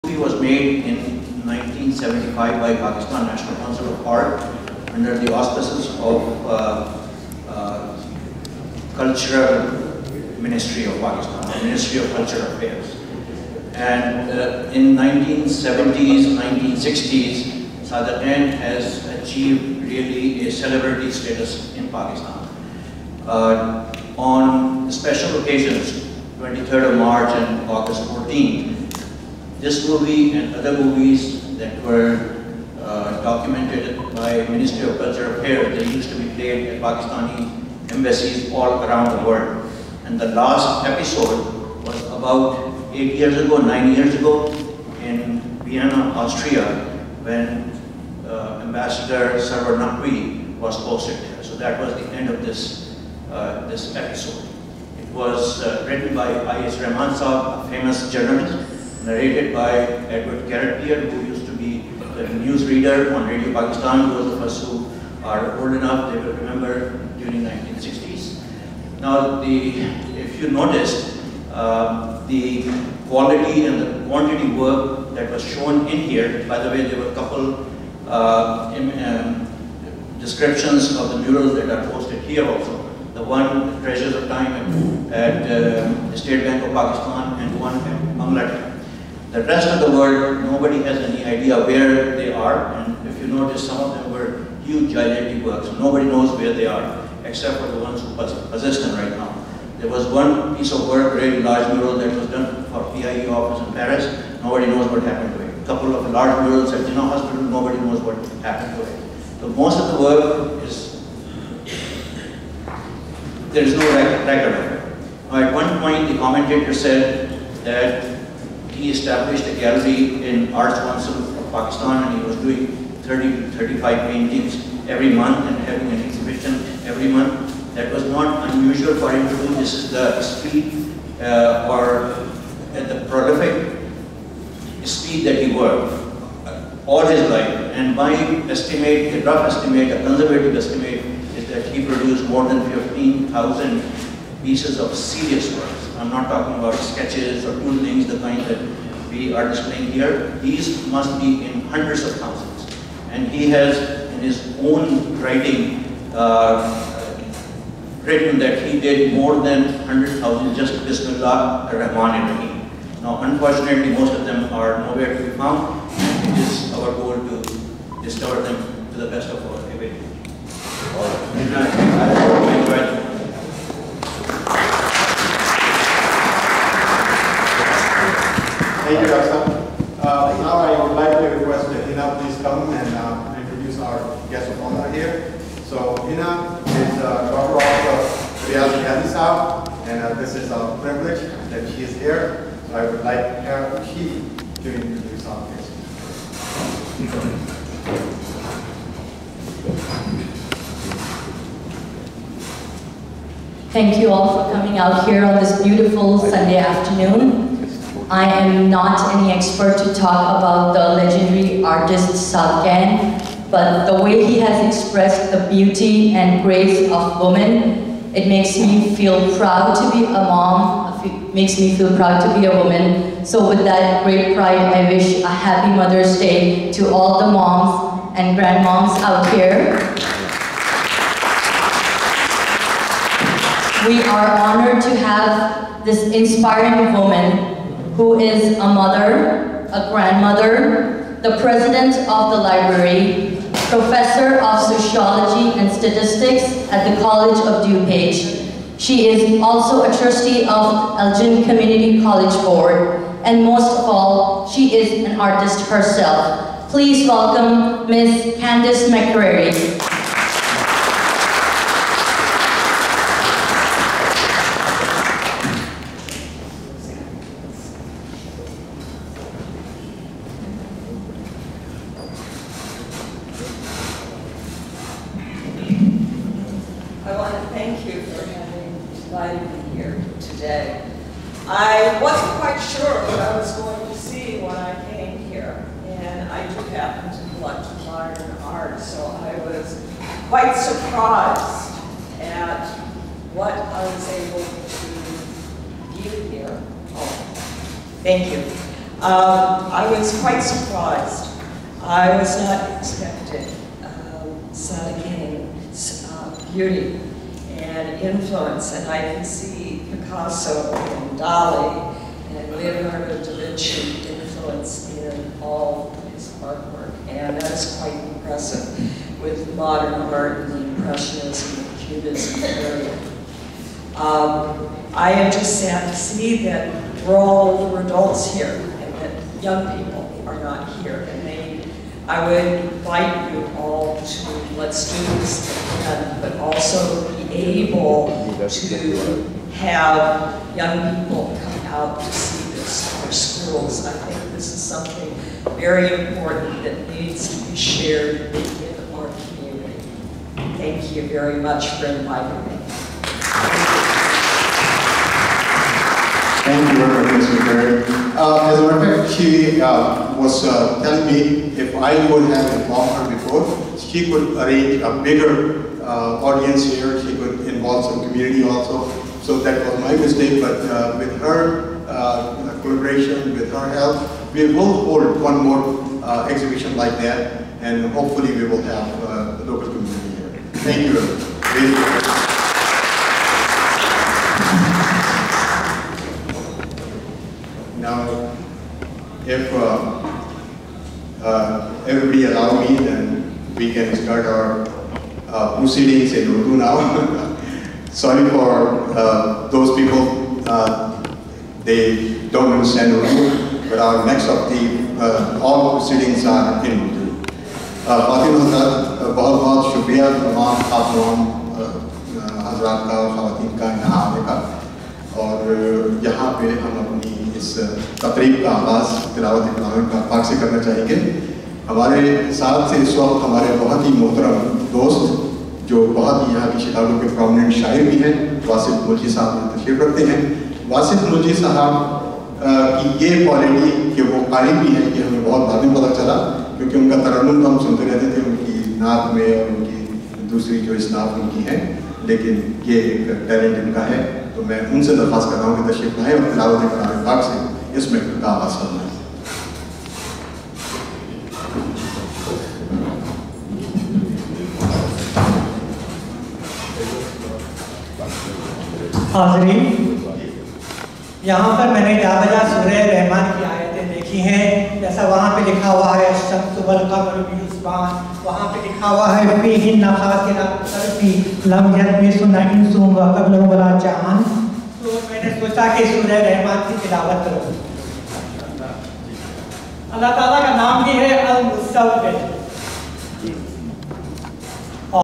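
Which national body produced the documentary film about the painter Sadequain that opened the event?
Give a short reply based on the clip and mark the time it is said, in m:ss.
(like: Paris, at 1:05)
Pakistan National Council of Art, at 0:02.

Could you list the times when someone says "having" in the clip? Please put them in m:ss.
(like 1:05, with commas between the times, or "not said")
2:05, 4:38.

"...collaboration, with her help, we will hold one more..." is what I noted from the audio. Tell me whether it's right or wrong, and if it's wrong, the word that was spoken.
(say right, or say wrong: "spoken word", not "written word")
right.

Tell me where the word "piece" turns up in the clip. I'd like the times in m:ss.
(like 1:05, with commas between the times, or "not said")
1:40, 2:24.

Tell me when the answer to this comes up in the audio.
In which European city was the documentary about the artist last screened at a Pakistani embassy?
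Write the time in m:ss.
0:45.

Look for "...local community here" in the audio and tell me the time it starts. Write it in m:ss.
6:19.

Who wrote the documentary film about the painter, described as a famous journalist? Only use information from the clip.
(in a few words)
I.A. Rahman.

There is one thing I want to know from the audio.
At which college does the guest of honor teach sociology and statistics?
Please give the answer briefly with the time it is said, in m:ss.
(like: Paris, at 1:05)
College of DuPage, at 4:06.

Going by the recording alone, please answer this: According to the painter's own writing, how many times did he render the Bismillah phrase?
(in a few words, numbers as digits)
100,000.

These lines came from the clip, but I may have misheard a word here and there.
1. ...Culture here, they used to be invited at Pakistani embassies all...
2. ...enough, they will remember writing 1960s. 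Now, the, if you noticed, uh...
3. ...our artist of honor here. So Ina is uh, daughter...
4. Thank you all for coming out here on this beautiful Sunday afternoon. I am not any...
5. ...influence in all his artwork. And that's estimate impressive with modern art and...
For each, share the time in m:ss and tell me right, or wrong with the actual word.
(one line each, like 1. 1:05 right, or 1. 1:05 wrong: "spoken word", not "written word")
1. 0:34 wrong: "played", not "invited"
2. 1:05 wrong: "during", not "writing"
3. 3:03 wrong: "guest", not "artist"
4. 3:23 right
5. 5:14 wrong: "quite", not "estimate".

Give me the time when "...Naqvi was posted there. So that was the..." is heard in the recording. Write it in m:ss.
0:49.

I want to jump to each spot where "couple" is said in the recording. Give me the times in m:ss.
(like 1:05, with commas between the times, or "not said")
1:17, 1:45.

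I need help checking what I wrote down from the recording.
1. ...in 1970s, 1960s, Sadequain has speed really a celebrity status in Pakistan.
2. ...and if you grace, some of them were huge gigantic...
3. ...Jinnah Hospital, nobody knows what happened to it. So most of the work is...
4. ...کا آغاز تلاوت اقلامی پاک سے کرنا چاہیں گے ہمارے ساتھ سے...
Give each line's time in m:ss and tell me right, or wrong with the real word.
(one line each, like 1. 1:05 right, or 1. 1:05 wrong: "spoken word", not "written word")
1. 0:14 wrong: "achieved", not "speed"
2. 1:32 wrong: "notice", not "grace"
3. 1:46 right
4. 6:58 right.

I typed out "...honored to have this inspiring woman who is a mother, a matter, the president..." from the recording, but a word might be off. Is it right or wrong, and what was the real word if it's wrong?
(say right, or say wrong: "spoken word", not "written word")
wrong: "grandmother", not "matter".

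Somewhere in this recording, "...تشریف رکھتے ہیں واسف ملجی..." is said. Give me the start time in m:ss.
7:09.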